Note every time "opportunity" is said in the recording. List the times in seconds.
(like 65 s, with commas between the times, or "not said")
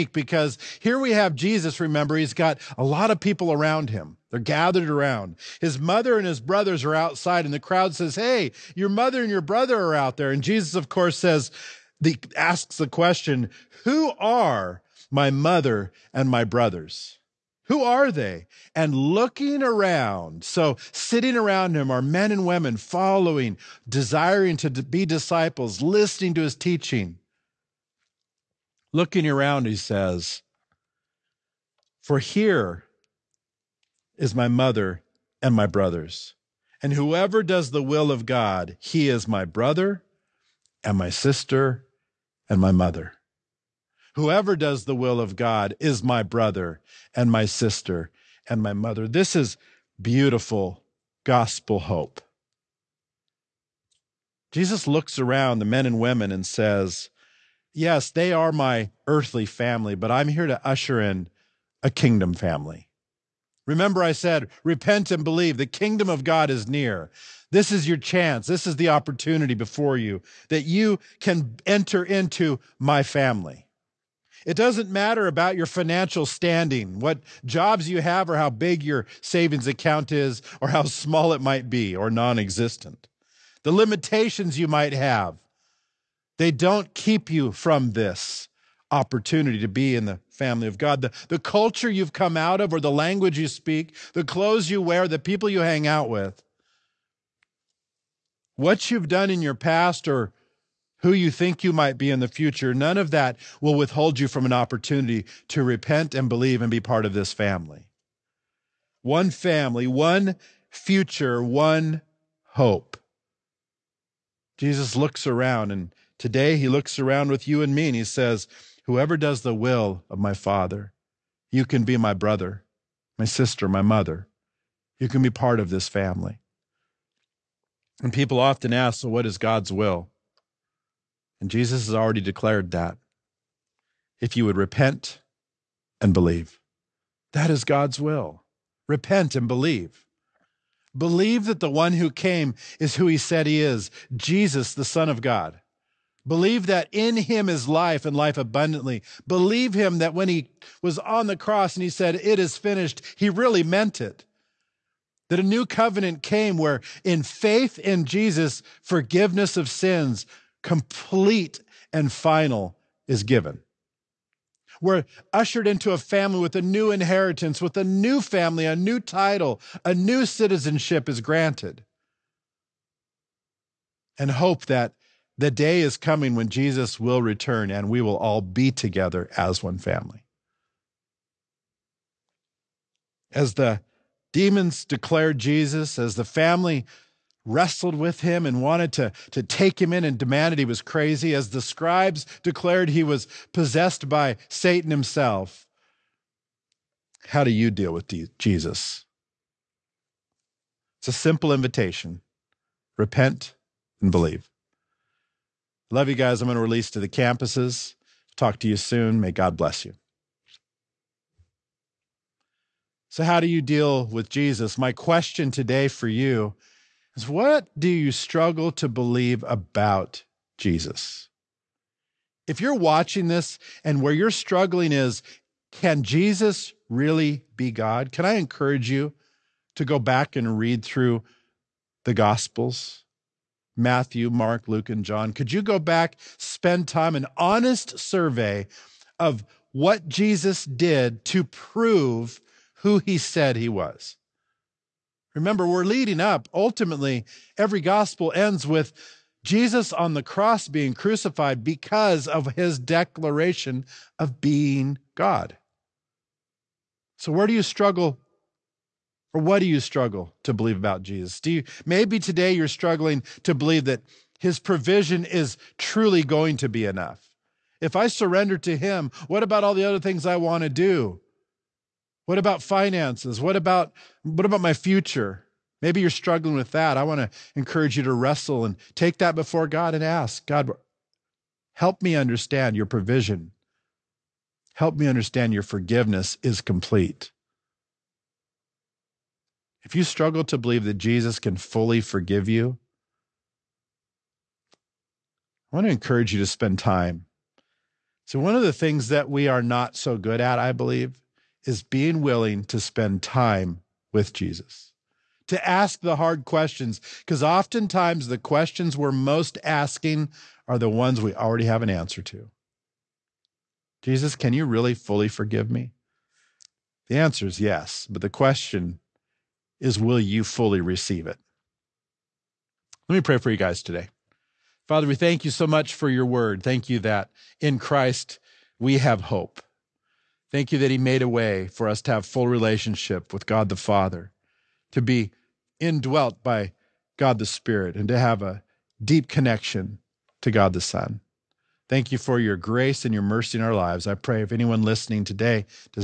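68 s, 88 s, 104 s.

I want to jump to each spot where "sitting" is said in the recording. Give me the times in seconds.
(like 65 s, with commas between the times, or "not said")
20 s.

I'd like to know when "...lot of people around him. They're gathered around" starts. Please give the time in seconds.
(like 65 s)
2 s.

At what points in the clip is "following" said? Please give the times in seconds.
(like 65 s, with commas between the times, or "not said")
22 s.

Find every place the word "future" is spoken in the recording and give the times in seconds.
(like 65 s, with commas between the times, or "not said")
102 s, 110 s, 274 s.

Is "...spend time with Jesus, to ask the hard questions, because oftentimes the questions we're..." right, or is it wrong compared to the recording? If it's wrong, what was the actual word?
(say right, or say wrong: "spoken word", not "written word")
right.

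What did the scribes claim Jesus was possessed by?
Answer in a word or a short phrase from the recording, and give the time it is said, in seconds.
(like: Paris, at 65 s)
Satan himself, at 194 s.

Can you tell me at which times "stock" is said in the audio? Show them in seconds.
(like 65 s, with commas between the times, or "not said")
not said.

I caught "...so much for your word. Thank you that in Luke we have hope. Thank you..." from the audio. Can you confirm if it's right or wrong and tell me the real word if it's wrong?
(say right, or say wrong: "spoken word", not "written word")
wrong: "Christ", not "Luke".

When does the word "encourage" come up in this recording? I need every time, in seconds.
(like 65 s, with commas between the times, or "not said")
228 s, 277 s, 295 s.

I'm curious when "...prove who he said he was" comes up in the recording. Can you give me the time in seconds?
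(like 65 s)
241 s.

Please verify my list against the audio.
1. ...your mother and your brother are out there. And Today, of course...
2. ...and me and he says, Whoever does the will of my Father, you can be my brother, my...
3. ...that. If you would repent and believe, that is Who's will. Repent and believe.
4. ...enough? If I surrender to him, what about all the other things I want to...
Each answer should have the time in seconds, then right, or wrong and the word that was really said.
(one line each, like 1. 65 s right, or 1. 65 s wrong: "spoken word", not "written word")
1. 8 s wrong: "Jesus", not "Today"
2. 117 s right
3. 132 s wrong: "God", not "Who"
4. 266 s right.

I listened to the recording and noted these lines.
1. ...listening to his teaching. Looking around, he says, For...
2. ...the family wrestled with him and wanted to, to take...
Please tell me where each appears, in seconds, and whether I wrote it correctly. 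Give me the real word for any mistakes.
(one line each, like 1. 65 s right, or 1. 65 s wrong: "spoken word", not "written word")
1. 25 s right
2. 186 s right.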